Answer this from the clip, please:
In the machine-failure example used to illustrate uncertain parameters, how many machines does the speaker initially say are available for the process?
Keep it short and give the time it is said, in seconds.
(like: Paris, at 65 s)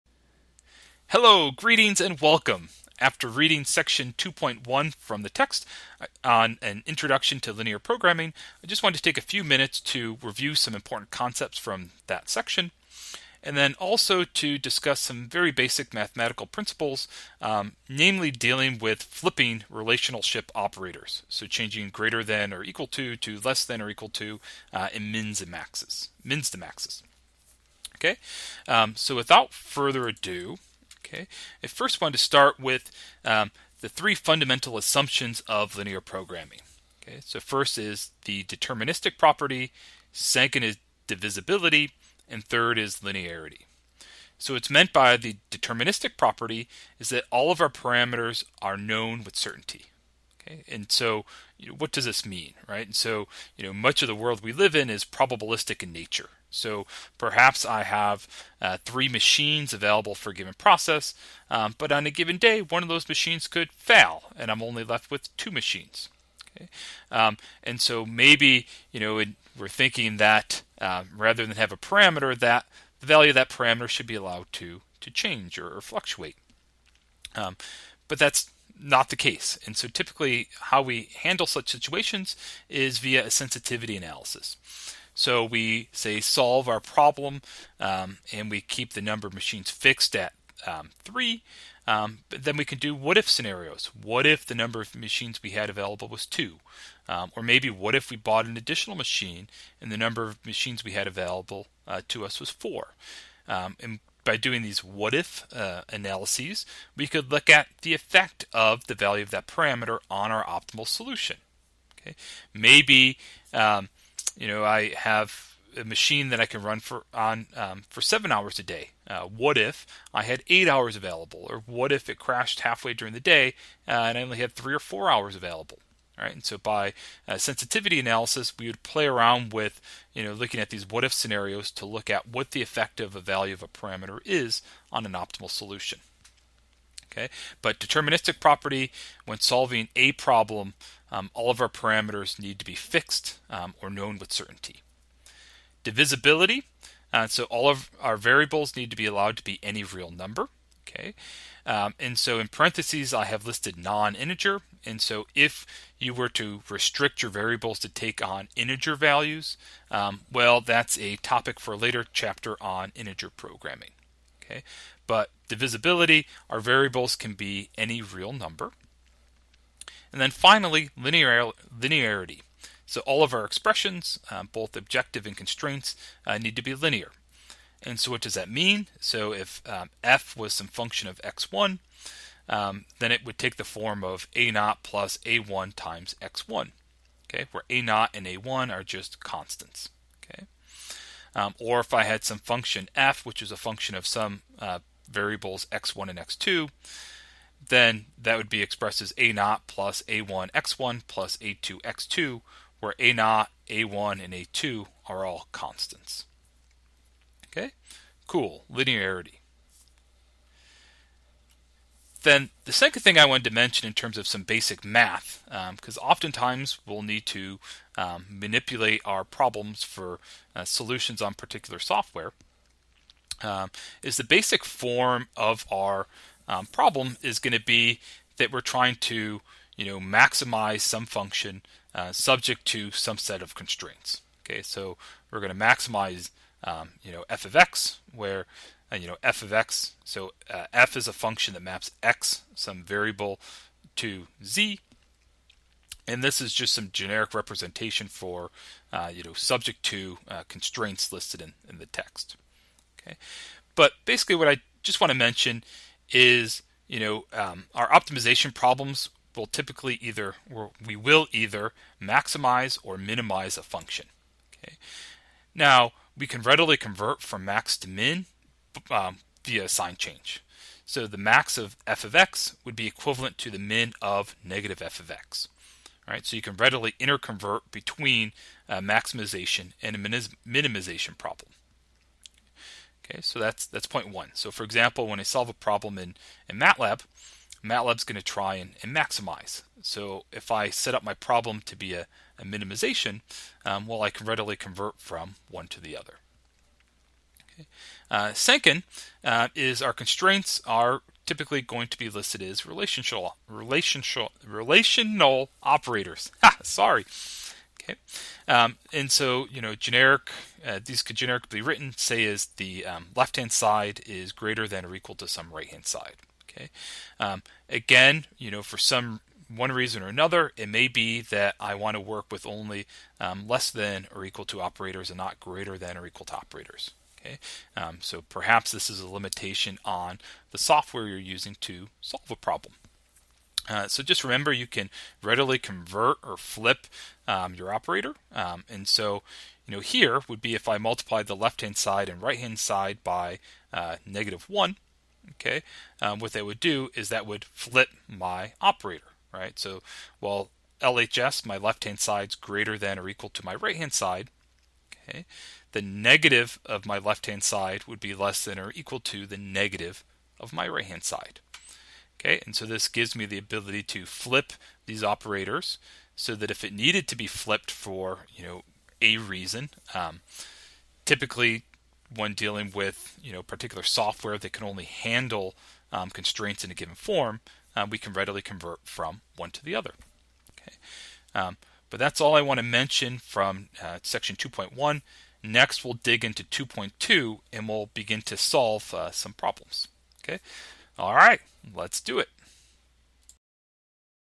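3, at 58 s.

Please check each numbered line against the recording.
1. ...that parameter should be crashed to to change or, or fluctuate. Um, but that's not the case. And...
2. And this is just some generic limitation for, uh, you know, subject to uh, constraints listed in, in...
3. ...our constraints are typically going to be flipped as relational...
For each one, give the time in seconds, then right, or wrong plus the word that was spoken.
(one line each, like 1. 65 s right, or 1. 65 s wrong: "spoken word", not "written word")
1. 73 s wrong: "allowed", not "crashed"
2. 246 s wrong: "representation", not "limitation"
3. 299 s wrong: "listed", not "flipped".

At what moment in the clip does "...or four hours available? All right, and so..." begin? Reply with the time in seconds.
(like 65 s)
124 s.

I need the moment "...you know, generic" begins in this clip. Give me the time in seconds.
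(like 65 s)
309 s.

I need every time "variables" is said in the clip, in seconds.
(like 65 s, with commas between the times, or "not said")
148 s, 157 s, 166 s, 195 s, 242 s.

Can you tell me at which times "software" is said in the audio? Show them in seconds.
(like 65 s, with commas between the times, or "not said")
221 s, 330 s, 373 s.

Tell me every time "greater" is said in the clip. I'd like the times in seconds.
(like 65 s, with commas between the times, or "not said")
21 s, 314 s, 325 s, 352 s.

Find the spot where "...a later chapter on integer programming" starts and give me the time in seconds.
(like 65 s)
161 s.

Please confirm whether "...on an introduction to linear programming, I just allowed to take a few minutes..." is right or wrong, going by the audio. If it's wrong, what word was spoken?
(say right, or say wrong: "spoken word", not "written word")
wrong: "wanted", not "allowed".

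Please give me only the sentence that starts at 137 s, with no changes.
Okay, but deterministic property when solving a problem, um, all of our parameters need to be fixed um, or known with certainty.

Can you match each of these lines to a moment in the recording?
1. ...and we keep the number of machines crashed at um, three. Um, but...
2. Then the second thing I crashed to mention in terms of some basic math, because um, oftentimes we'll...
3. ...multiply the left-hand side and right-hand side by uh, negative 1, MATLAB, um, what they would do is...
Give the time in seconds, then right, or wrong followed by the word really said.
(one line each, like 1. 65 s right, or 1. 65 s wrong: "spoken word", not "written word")
1. 88 s wrong: "fixed", not "crashed"
2. 212 s wrong: "wanted", not "crashed"
3. 340 s wrong: "Okay", not "MATLAB".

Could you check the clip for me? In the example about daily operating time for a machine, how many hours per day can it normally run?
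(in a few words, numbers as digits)
7.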